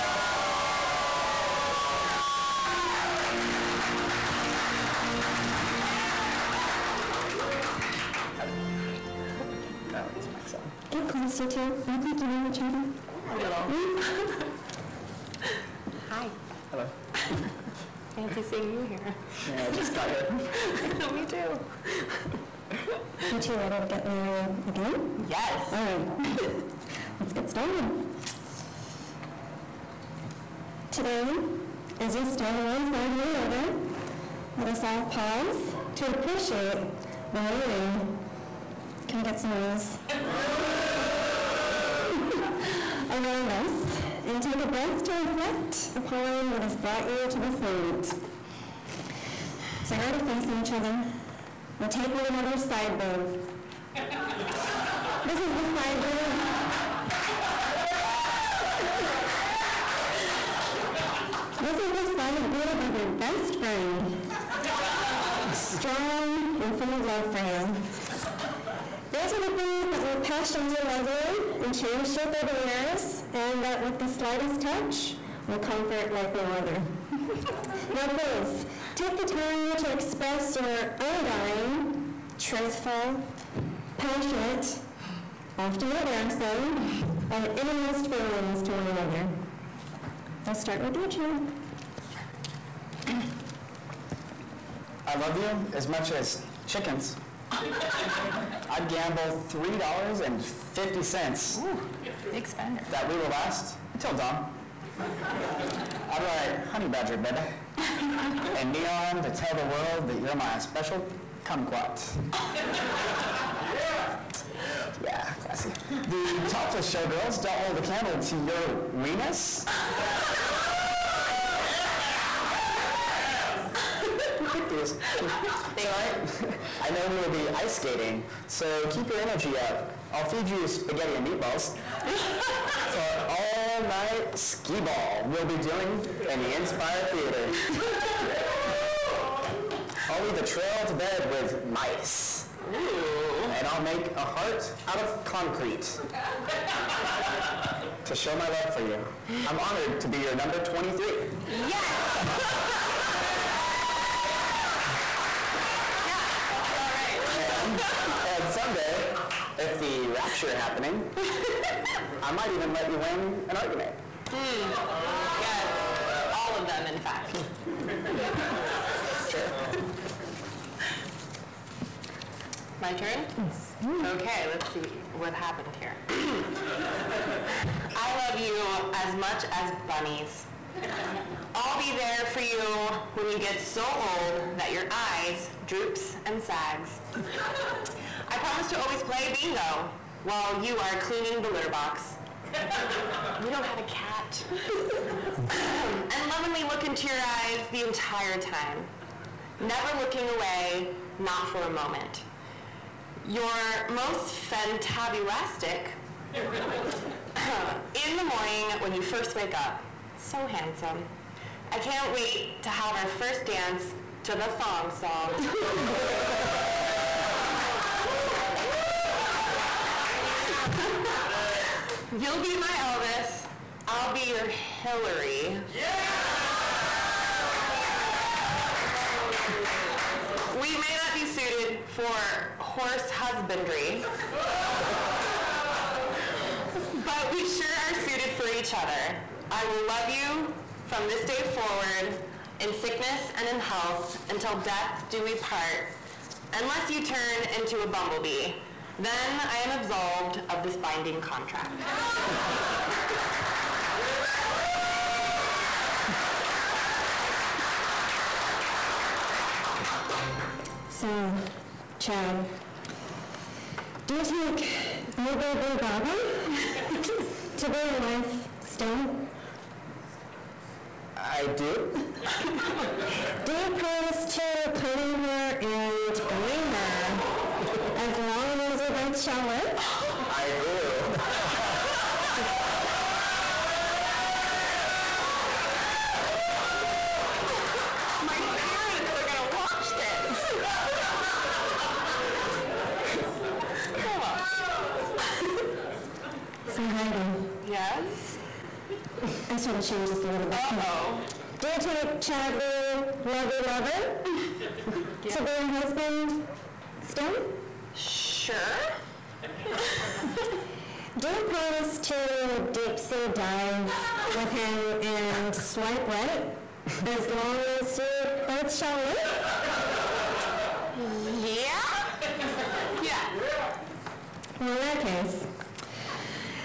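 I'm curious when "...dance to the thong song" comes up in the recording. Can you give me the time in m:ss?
3:33.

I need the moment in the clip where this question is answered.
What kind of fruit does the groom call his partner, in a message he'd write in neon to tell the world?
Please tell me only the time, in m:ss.
1:51.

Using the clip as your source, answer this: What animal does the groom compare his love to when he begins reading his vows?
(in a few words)
chickens.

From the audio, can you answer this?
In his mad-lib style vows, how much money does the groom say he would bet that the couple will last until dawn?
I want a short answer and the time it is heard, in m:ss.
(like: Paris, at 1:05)
$3.50, at 1:39.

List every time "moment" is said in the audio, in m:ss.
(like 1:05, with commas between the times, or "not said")
0:47, 3:21.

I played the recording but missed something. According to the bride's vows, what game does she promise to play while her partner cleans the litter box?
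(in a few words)
bingo.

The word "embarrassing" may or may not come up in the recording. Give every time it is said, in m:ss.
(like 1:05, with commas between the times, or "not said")
1:25.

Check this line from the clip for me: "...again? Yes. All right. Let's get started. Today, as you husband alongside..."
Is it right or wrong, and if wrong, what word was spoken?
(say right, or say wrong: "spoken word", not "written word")
wrong: "stand", not "husband".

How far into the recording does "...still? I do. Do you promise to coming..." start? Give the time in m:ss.
4:28.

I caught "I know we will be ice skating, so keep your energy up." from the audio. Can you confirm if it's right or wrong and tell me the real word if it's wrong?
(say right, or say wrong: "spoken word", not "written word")
right.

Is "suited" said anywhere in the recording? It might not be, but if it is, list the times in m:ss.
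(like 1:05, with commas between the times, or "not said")
3:51, 3:57.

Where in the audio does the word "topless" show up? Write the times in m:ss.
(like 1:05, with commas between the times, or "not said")
1:56.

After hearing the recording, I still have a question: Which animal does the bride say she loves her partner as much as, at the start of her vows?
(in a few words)
bunnies.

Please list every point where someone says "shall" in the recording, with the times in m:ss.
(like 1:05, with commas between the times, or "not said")
4:39, 5:18.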